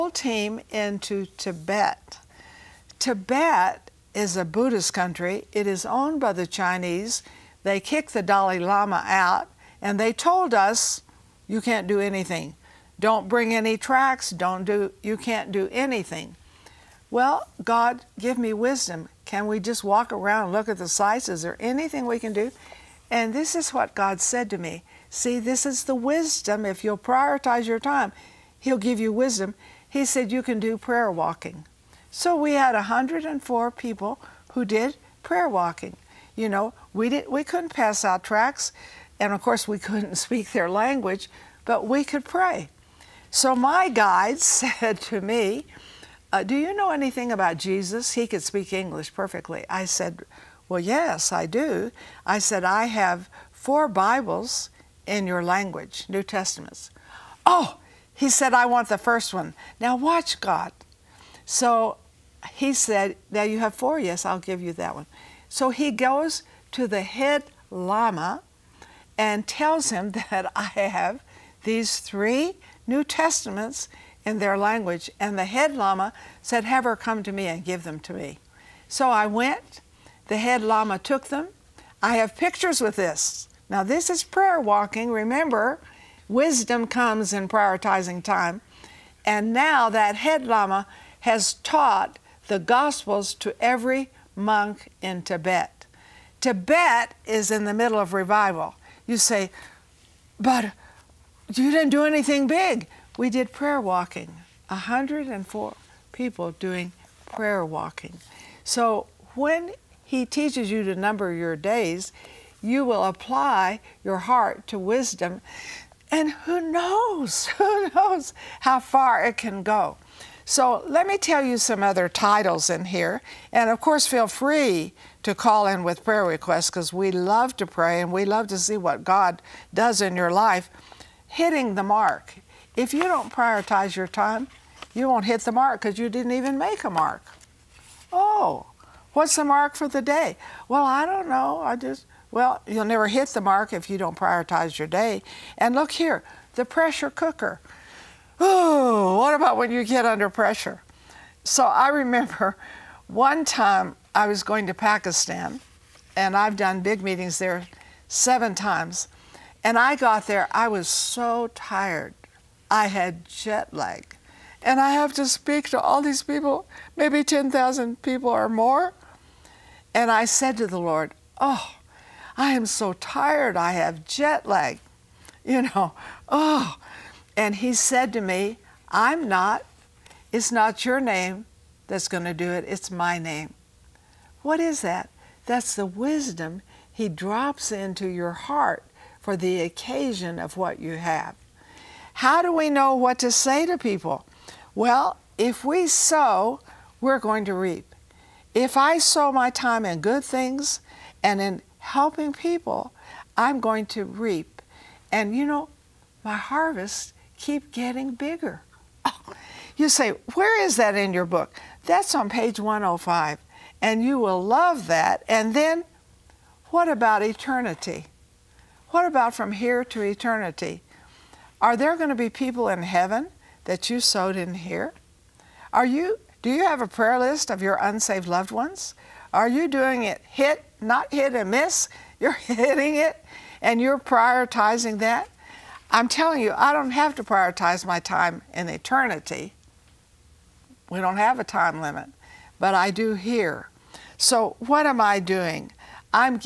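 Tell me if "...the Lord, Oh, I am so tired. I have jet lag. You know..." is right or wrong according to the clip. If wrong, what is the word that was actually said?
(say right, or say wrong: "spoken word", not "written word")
right.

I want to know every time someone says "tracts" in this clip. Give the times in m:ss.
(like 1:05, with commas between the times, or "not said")
0:13, 0:38.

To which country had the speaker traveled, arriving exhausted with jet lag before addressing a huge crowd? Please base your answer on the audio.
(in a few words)
Pakistan.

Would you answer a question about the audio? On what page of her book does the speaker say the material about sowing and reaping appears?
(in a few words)
105.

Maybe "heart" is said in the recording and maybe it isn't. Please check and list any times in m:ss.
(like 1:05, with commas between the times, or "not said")
1:54, 3:08.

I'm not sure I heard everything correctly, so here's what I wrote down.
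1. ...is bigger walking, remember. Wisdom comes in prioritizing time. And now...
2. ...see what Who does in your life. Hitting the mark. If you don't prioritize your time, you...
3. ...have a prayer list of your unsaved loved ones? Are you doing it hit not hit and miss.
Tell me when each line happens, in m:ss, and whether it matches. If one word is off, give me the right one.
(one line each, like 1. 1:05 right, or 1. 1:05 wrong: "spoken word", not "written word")
1. 1:24 wrong: "prayer", not "bigger"
2. 2:08 wrong: "God", not "Who"
3. 3:46 right.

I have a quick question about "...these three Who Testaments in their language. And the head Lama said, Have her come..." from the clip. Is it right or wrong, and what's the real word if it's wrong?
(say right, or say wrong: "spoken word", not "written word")
wrong: "New", not "Who".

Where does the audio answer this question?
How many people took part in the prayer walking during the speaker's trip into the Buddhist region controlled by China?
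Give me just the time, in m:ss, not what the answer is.
0:32.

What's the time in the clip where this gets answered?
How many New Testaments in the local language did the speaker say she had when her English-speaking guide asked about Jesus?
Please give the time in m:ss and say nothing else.
0:53.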